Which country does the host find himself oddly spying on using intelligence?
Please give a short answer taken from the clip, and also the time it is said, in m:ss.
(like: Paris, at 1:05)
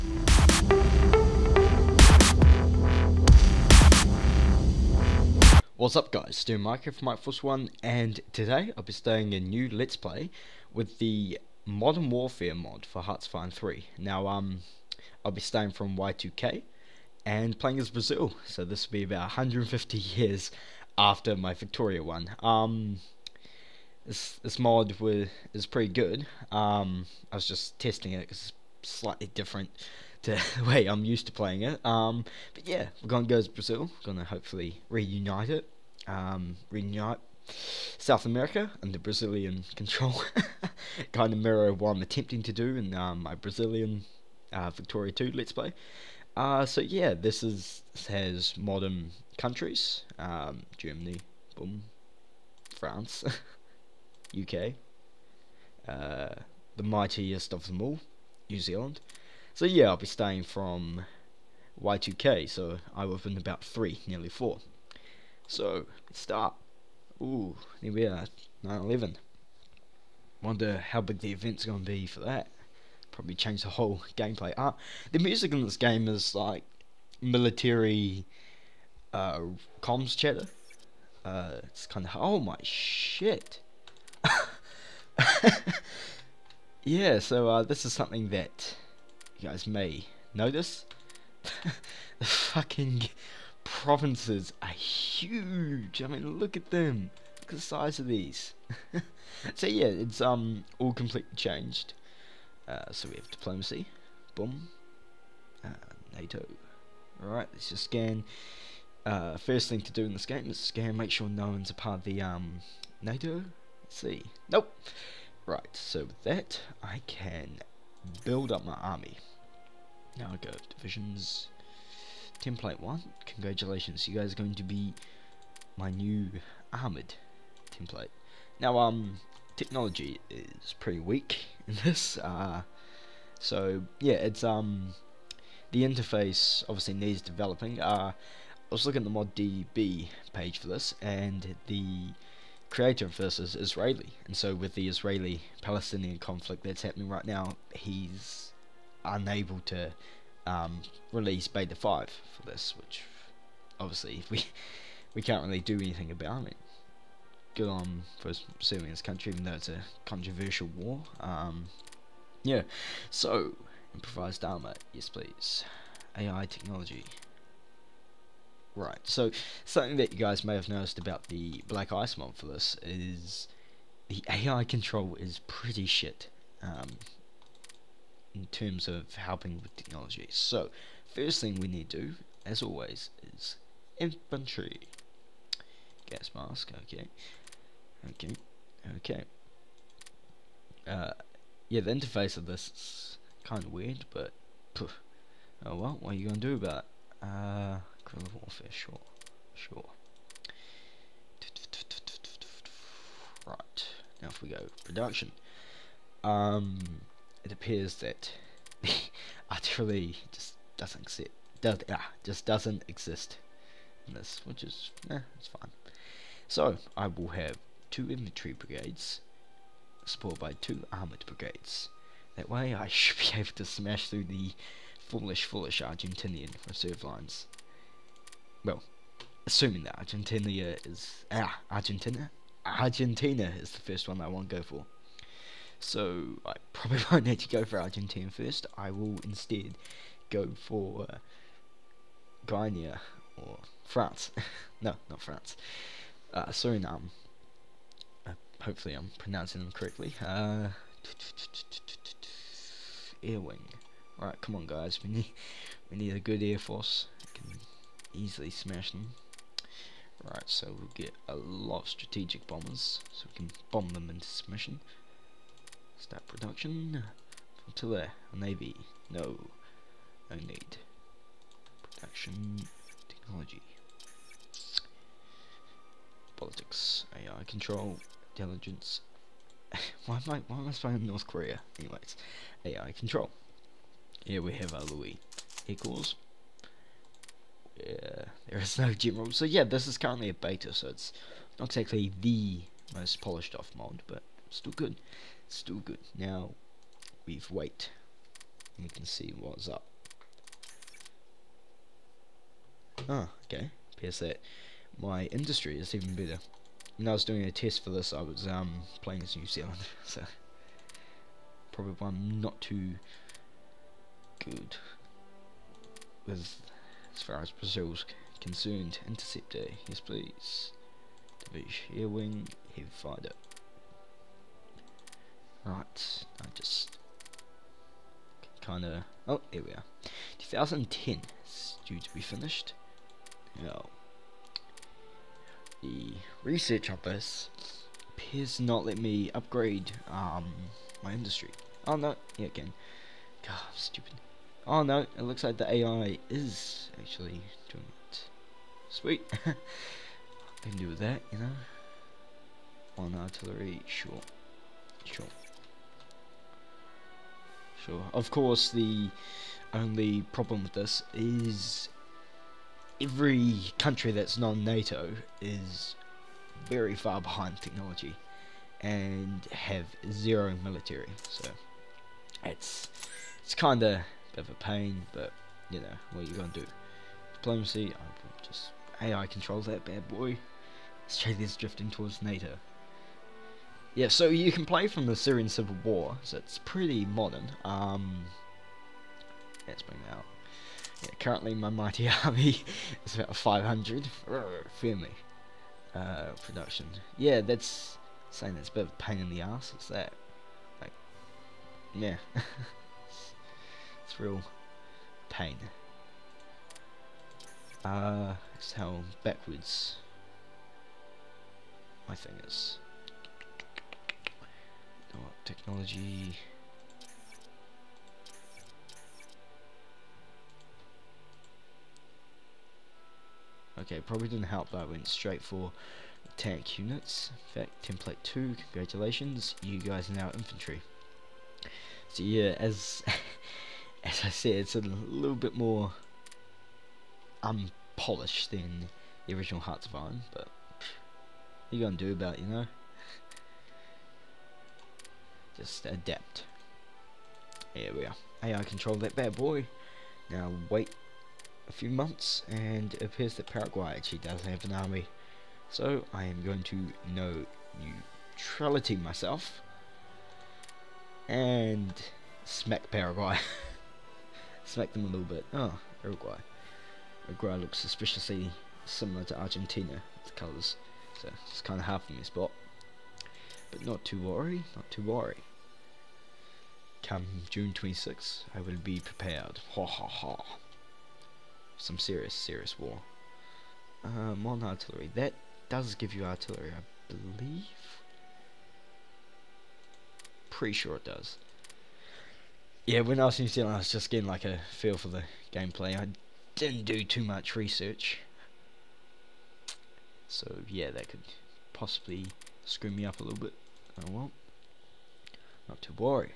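North Korea, at 4:41.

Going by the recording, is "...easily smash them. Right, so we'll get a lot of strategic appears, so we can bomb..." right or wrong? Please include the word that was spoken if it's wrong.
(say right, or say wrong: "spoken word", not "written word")
wrong: "bombers", not "appears".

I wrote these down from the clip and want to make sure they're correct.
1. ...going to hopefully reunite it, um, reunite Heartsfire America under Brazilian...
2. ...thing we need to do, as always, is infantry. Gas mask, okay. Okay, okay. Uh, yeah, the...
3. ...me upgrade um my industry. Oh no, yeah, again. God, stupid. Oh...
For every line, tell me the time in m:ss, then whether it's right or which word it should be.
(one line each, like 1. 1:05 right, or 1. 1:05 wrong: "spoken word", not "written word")
1. 0:34 wrong: "South", not "Heartsfire"
2. 3:01 right
3. 5:38 right.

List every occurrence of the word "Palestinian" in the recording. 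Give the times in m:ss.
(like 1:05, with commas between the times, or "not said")
2:25.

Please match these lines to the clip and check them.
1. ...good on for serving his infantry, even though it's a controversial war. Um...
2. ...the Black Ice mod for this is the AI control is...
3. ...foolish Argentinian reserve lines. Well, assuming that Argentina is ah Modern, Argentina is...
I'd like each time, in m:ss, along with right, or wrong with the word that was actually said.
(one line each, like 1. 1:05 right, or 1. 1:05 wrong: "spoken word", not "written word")
1. 2:37 wrong: "country", not "infantry"
2. 2:51 right
3. 3:45 wrong: "Argentina", not "Modern".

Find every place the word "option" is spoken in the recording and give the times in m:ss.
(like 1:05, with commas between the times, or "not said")
not said.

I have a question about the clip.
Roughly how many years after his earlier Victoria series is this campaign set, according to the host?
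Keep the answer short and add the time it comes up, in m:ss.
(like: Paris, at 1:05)
150, at 0:19.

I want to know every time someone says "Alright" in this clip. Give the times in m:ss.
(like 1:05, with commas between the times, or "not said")
1:47.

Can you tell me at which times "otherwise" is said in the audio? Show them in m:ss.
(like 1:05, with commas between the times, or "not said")
not said.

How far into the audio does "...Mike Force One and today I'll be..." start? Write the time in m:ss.
0:07.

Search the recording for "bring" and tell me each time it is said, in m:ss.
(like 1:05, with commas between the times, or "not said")
6:29.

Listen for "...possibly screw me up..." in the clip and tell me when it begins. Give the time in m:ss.
8:21.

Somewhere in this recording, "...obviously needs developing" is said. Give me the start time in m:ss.
2:16.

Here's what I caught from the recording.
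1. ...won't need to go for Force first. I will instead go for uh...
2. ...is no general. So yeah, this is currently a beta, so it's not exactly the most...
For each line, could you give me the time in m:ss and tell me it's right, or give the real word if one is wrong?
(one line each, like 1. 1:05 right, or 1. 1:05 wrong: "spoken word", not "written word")
1. 3:57 wrong: "Argentina", not "Force"
2. 4:48 right.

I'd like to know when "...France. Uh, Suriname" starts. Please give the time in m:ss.
4:05.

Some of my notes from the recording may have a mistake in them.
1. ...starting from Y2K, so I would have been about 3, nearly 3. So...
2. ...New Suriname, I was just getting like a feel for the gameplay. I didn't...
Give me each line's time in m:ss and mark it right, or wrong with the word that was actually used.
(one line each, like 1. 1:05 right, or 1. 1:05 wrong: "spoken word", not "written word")
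1. 1:00 wrong: "4", not "3"
2. 8:13 wrong: "Zealand", not "Suriname".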